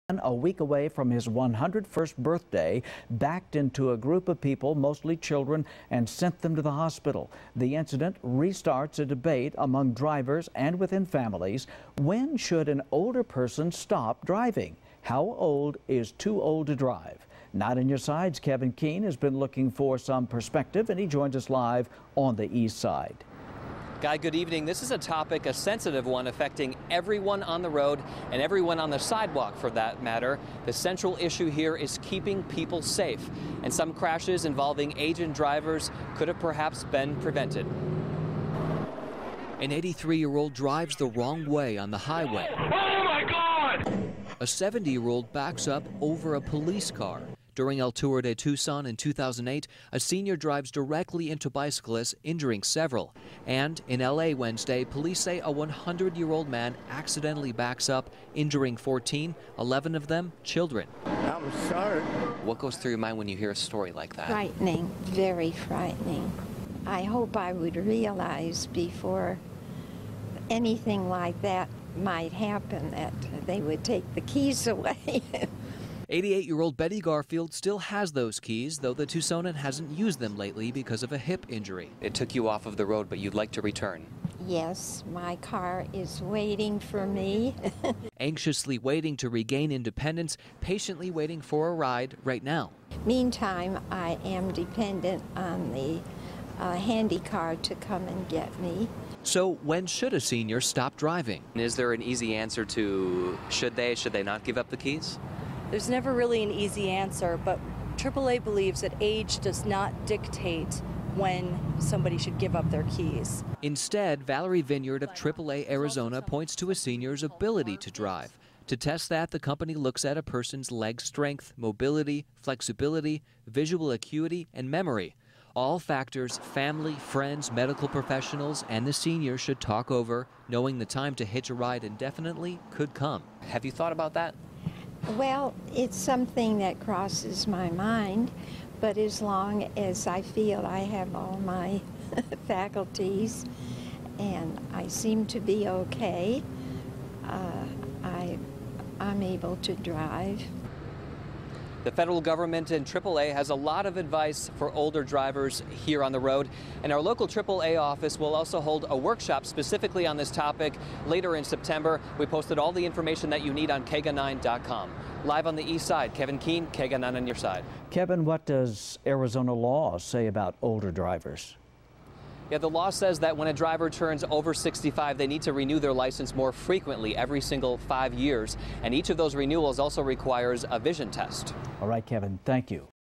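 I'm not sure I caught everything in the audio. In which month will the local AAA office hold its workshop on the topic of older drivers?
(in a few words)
September.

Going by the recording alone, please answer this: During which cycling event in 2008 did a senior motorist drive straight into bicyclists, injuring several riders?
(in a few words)
El Tour de Tucson.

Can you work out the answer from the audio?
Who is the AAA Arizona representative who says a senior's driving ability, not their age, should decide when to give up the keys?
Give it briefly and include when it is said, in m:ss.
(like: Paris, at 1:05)
Valerie Vinyard, at 1:54.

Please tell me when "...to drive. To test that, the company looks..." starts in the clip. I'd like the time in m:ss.
1:57.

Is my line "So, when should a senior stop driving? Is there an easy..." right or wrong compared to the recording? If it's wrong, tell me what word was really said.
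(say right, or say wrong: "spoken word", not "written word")
right.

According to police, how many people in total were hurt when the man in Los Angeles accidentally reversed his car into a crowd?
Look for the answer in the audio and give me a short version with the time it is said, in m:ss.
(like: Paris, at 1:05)
14, at 0:58.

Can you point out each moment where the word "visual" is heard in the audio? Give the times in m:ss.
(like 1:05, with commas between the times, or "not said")
2:03.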